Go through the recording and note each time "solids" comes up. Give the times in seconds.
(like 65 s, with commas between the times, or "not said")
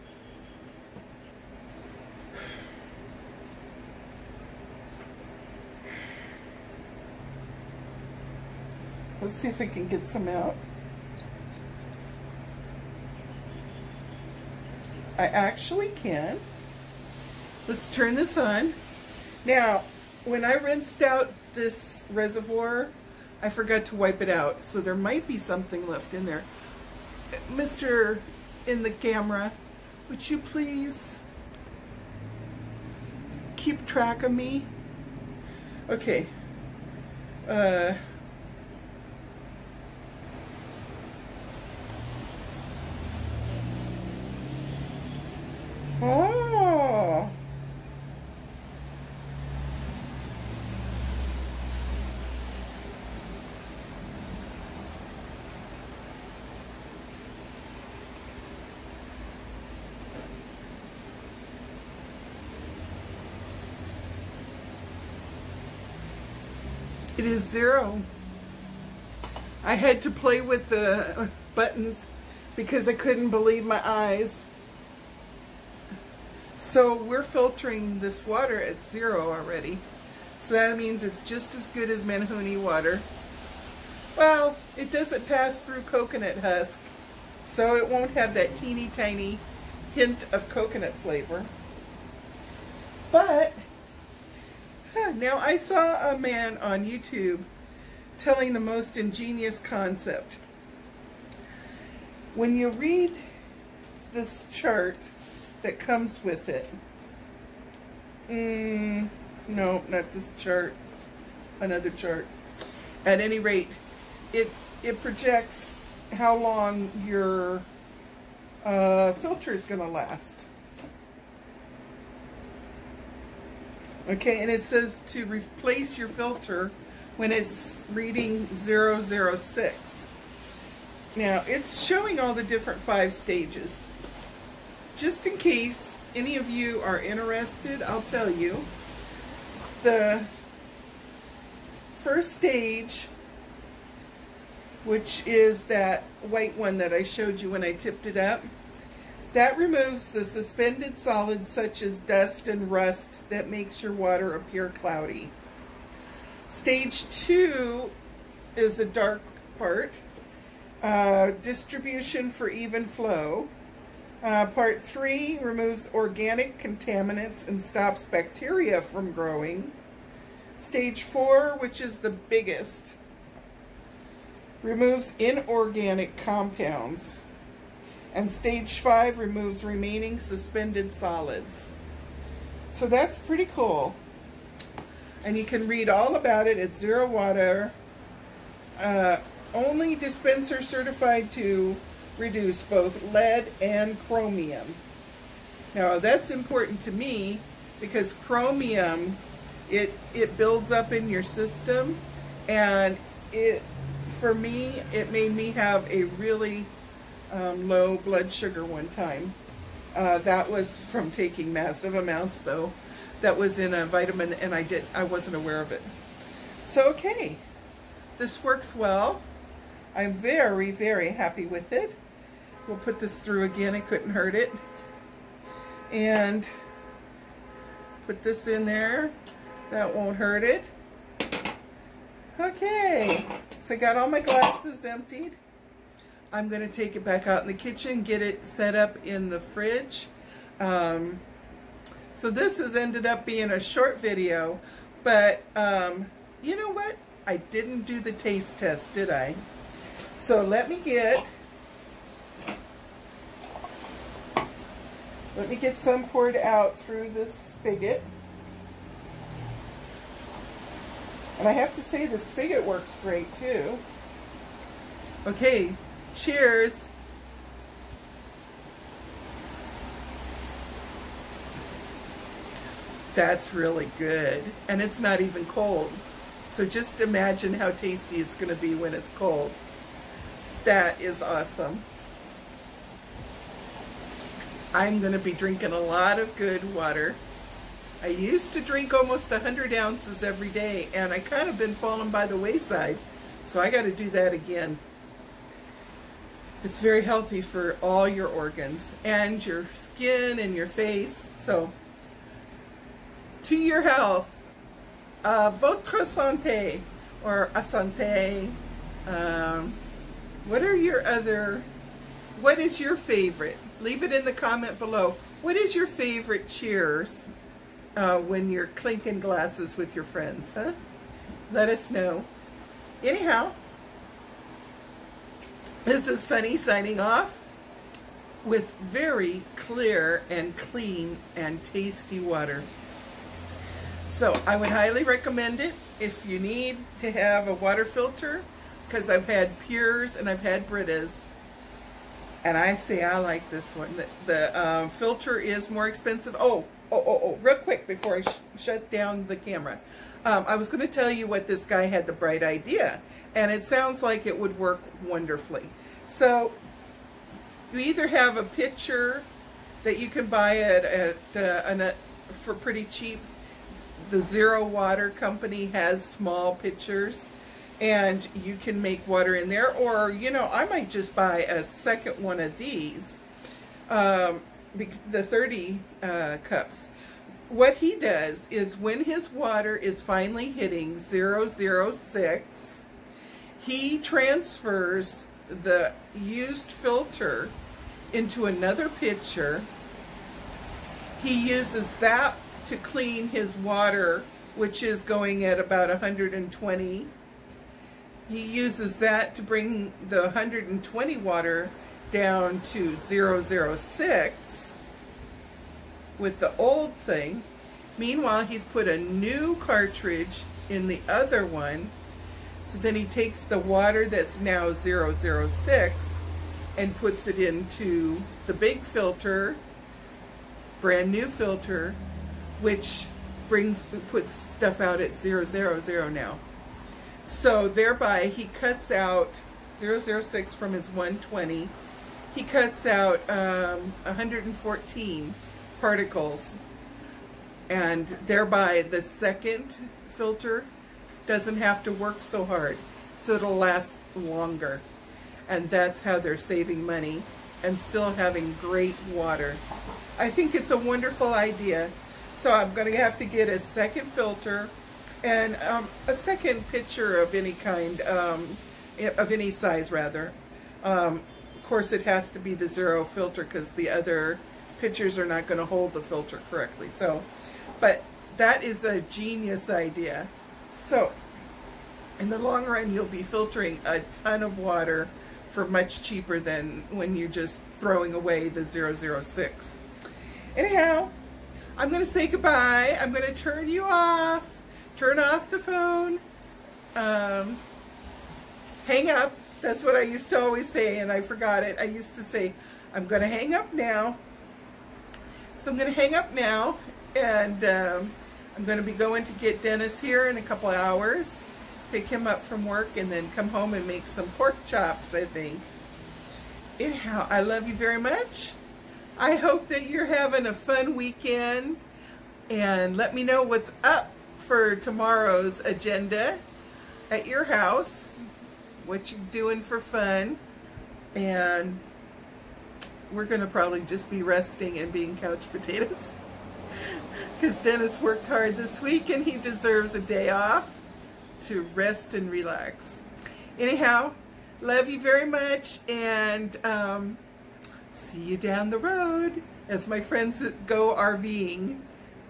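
150 s, 180 s.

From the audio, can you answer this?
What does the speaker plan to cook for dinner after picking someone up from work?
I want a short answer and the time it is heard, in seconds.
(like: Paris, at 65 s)
pork chops, at 504 s.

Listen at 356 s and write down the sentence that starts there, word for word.
So you either have a picture that you can buy at, at uh, an, uh, for pretty cheap.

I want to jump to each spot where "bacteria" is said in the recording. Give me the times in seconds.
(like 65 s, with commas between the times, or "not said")
168 s.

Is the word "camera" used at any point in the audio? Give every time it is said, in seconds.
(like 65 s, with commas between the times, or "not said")
28 s, 349 s.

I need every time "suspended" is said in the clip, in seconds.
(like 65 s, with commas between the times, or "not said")
150 s, 180 s.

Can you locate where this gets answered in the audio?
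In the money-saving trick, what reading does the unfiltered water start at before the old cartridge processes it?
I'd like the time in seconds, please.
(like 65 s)
395 s.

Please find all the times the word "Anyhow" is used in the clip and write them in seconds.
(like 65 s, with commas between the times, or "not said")
323 s, 480 s, 506 s, 533 s.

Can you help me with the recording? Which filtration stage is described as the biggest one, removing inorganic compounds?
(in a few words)
Stage four.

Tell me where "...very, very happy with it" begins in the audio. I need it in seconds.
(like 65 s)
220 s.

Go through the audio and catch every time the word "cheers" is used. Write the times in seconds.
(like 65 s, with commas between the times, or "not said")
266 s, 316 s.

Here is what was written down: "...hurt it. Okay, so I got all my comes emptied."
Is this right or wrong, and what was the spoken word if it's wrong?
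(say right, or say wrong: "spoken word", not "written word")
wrong: "glasses", not "comes".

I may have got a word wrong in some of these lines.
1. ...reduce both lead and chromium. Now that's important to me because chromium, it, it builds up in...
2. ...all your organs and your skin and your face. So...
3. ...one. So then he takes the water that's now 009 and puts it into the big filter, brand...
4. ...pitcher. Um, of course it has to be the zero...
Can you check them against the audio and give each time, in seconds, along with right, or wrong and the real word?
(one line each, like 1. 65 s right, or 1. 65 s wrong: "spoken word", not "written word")
1. 192 s right
2. 297 s right
3. 411 s wrong: "006", not "009"
4. 459 s wrong: "rather", not "pitcher".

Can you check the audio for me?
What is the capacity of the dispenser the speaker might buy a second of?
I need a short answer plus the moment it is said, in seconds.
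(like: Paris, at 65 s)
30 cups, at 375 s.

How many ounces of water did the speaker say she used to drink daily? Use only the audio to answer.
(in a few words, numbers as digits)
100.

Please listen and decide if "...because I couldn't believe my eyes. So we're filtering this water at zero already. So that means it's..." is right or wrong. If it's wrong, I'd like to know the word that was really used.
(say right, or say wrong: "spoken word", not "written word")
right.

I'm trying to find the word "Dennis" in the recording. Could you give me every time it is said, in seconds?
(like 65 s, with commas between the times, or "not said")
499 s, 527 s.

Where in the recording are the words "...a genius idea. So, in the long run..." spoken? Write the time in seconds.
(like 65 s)
468 s.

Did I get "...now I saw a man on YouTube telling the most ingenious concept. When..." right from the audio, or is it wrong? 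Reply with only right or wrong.
right.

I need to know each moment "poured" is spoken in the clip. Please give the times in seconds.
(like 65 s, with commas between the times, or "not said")
256 s.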